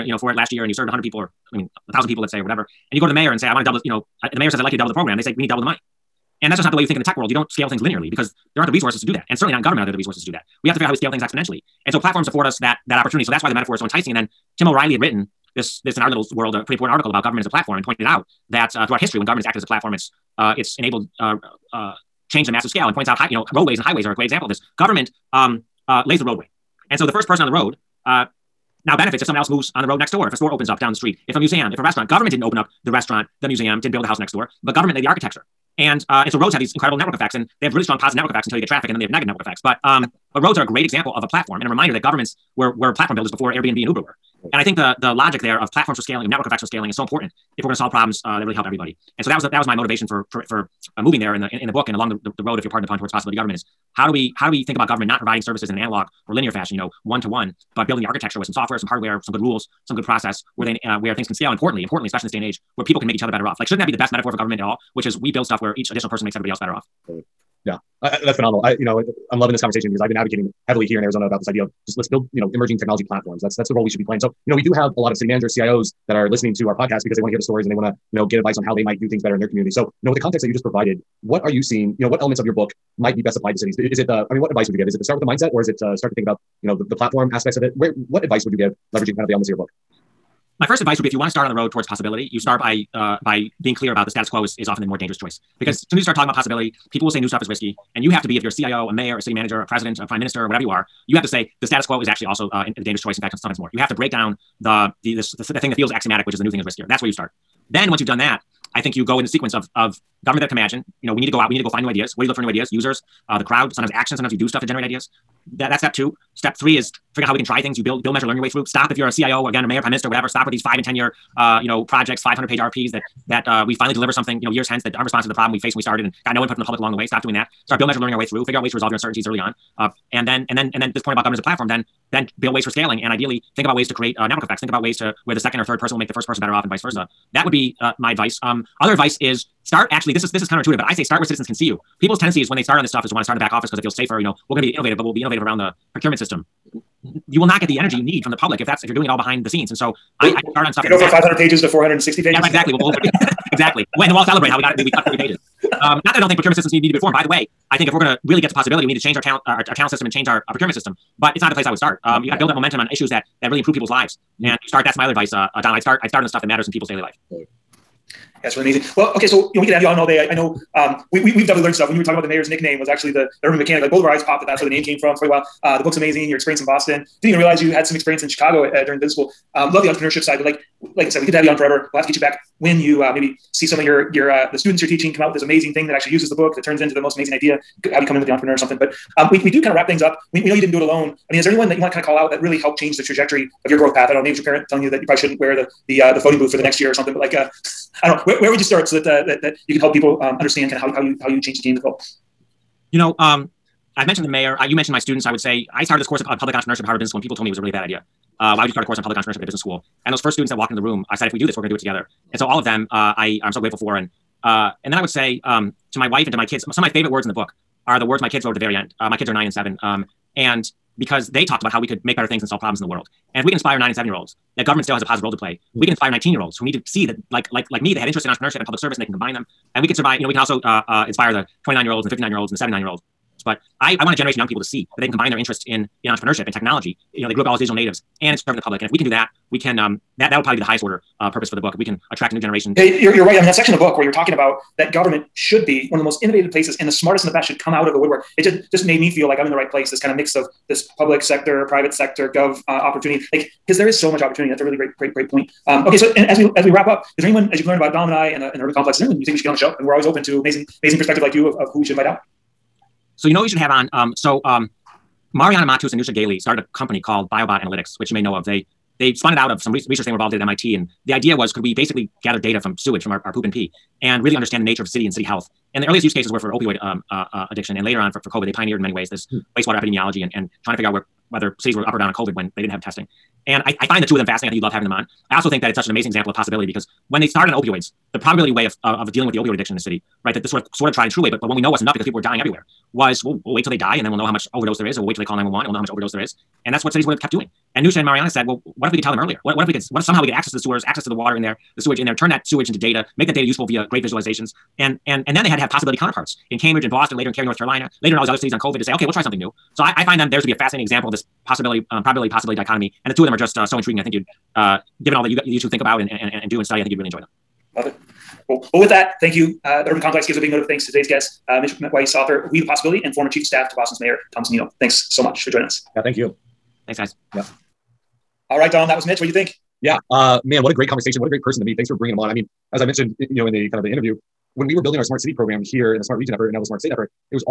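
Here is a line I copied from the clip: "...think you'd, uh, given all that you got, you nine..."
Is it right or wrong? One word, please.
wrong.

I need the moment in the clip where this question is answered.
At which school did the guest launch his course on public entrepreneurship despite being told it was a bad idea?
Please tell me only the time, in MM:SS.
03:26.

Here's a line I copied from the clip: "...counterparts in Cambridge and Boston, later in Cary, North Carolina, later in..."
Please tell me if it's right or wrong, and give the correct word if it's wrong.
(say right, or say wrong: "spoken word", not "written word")
right.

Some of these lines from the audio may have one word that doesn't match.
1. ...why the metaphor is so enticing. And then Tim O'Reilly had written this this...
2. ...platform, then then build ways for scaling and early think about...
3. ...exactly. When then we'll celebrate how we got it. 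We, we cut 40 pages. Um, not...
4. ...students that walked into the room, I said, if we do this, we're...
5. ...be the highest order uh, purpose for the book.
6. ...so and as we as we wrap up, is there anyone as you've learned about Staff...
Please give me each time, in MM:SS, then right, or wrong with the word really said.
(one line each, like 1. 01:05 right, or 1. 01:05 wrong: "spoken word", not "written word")
1. 00:13 right
2. 02:11 wrong: "ideally", not "early"
3. 02:33 right
4. 03:30 right
5. 04:00 right
6. 04:15 wrong: "Dom", not "Staff".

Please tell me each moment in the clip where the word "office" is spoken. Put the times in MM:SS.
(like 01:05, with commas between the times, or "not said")
02:23.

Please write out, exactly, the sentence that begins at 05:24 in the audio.
Thanks so much for joining us.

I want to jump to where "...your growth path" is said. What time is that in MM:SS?
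03:13.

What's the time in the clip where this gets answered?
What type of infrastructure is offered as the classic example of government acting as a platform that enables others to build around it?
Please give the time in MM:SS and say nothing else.
00:23.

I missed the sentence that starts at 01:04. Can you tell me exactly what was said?
Which is we build stuff where each additional person makes everybody else better off.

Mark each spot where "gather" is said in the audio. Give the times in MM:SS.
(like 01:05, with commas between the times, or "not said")
04:32.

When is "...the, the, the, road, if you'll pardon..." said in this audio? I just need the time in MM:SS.
00:52.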